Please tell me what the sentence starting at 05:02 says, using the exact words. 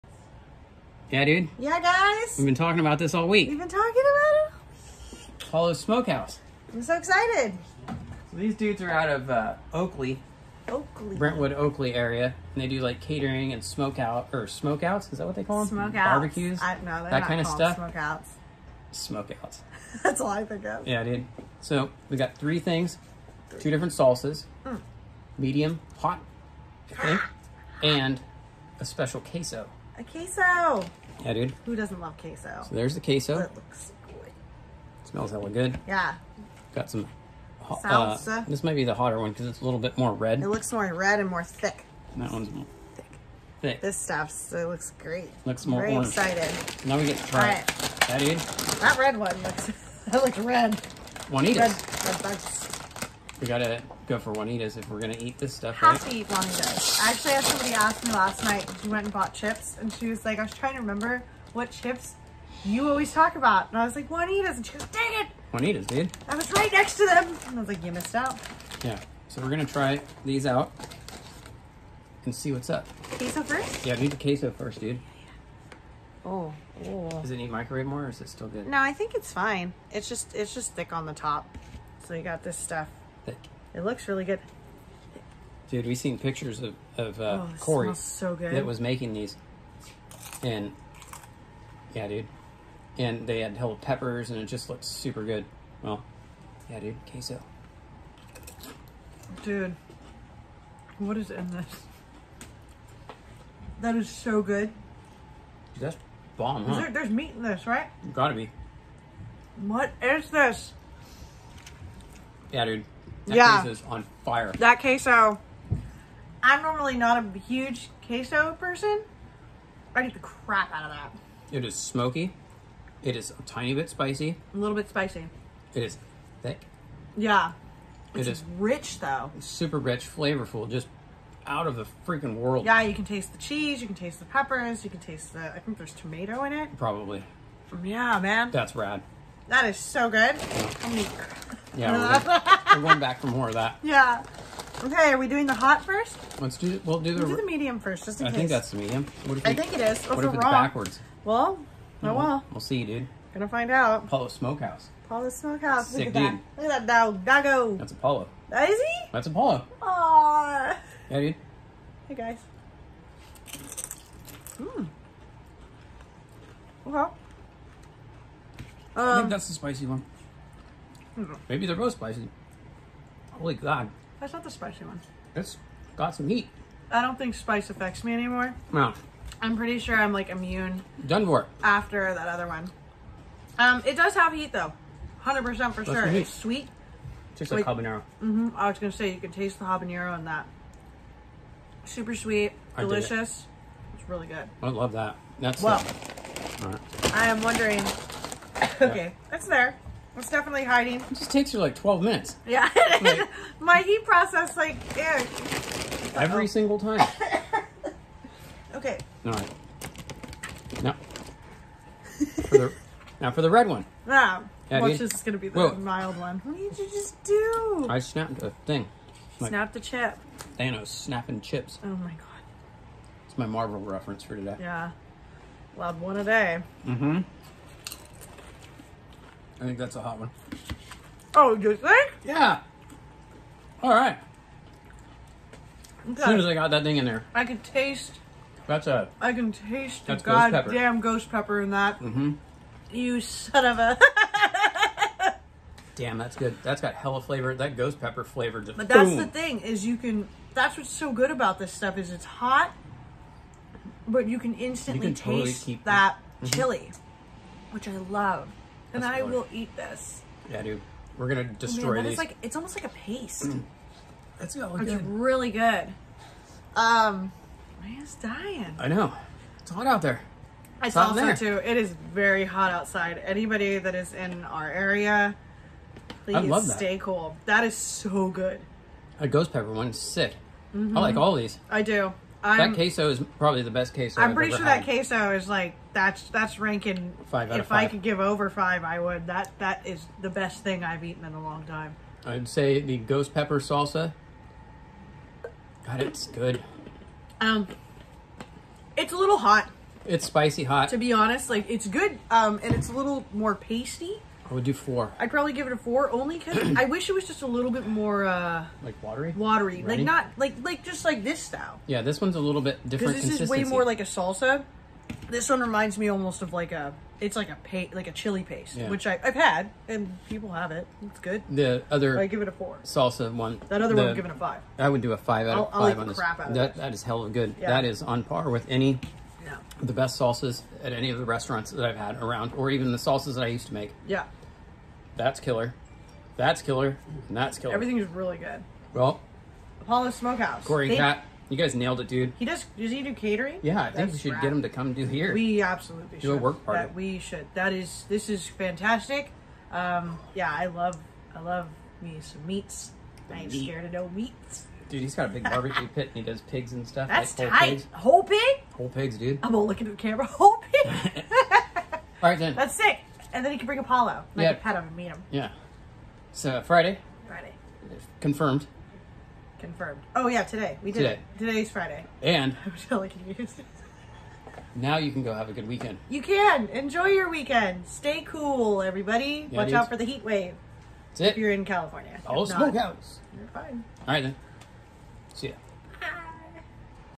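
Um, and it's a little more pasty.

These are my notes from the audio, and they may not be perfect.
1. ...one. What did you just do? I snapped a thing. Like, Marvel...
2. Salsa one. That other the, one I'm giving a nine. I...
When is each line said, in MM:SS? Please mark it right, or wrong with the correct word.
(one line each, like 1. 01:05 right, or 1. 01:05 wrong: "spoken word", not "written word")
1. 03:36 wrong: "Snap", not "Marvel"
2. 05:22 wrong: "five", not "nine".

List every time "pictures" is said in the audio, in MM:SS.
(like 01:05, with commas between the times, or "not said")
01:26.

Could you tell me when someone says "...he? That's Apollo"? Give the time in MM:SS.
02:38.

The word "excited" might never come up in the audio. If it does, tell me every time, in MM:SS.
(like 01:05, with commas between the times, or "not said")
00:06, 00:46.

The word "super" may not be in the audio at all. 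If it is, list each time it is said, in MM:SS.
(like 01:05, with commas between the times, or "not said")
01:34, 02:09, 03:11.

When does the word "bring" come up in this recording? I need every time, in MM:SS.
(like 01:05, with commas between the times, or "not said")
06:03.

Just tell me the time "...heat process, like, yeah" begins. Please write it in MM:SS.
03:23.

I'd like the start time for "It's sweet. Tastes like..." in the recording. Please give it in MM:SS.
03:06.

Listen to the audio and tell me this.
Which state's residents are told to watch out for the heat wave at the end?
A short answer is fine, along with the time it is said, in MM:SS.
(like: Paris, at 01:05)
California, at 06:21.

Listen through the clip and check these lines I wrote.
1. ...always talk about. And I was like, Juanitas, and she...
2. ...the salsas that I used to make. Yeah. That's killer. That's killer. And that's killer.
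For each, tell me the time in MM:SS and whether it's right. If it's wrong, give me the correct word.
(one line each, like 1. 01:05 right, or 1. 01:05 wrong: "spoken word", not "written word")
1. 01:02 right
2. 05:32 right.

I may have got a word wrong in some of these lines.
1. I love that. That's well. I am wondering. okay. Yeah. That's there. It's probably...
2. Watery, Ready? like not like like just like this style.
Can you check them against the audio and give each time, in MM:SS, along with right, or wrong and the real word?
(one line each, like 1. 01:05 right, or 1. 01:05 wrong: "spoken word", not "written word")
1. 03:14 wrong: "definitely", not "probably"
2. 05:09 right.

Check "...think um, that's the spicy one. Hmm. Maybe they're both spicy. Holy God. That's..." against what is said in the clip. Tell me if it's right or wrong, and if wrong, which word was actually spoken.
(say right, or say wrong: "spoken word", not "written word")
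right.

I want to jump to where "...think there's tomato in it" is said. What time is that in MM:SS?
02:15.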